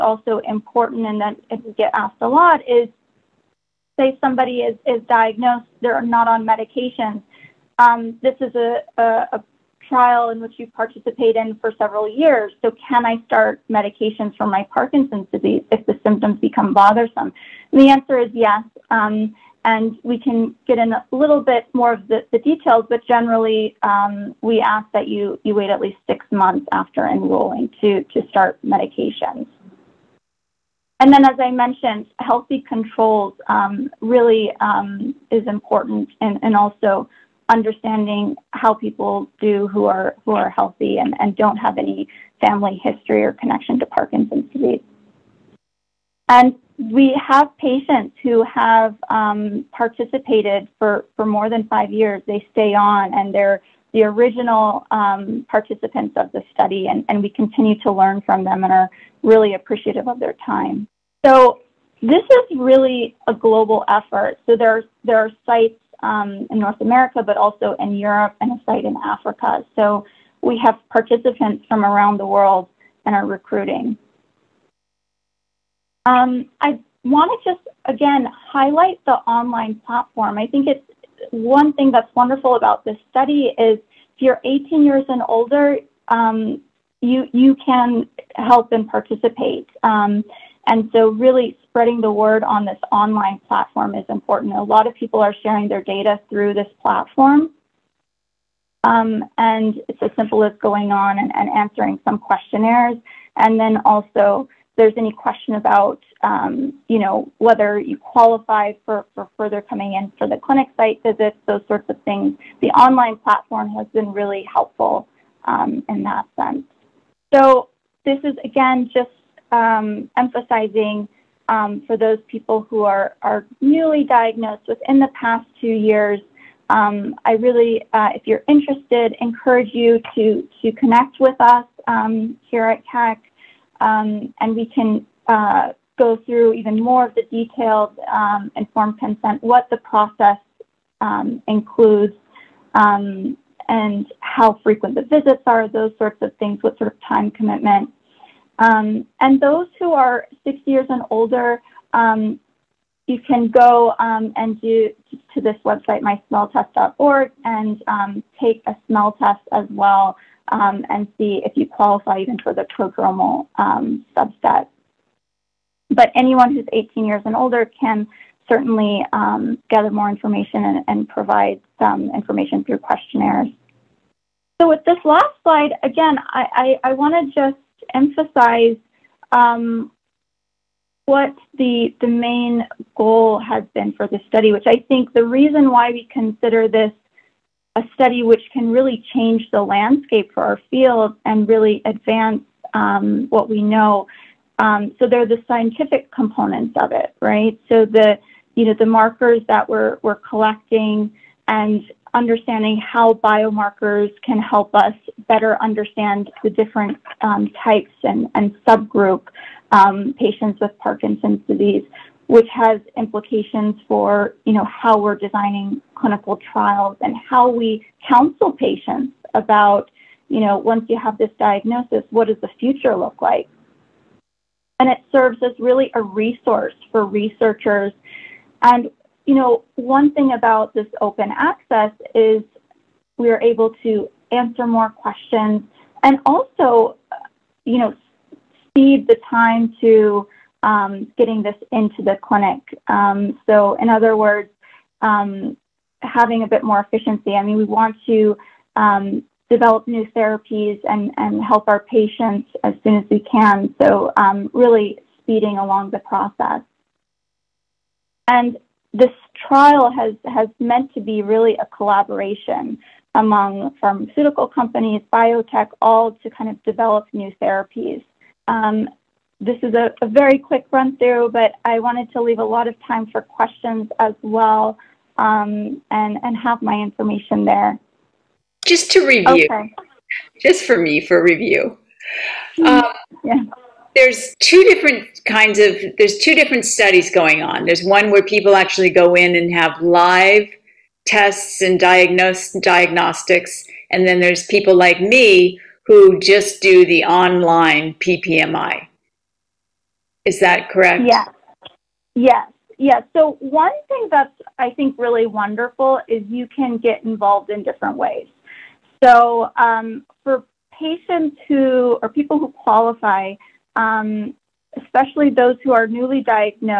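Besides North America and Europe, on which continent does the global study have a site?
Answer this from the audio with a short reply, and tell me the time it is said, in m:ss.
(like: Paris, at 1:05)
Africa, at 1:09.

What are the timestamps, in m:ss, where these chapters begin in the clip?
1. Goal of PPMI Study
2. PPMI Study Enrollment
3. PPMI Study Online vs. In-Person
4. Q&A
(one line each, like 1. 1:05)
1. 2:53
2. 1:00
3. 4:38
4. 4:27.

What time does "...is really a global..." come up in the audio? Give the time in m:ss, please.
1:02.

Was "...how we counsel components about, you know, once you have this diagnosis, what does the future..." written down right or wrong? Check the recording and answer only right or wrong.
wrong.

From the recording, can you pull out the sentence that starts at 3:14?
Um, so there are the scientific components of it, right?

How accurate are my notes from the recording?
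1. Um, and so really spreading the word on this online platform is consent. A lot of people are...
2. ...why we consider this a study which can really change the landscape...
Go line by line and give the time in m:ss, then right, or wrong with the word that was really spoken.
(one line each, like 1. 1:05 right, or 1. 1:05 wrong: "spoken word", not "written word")
1. 1:29 wrong: "important", not "consent"
2. 3:05 right.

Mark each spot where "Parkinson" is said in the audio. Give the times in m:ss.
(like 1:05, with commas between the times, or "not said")
0:14, 0:43, 3:30.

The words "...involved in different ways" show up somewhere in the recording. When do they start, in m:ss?
5:07.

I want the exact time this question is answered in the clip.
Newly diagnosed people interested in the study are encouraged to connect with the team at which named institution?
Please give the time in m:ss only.
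2:12.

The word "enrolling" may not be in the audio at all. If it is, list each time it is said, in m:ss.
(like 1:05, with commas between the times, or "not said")
0:27.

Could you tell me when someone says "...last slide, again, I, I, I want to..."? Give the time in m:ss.
2:55.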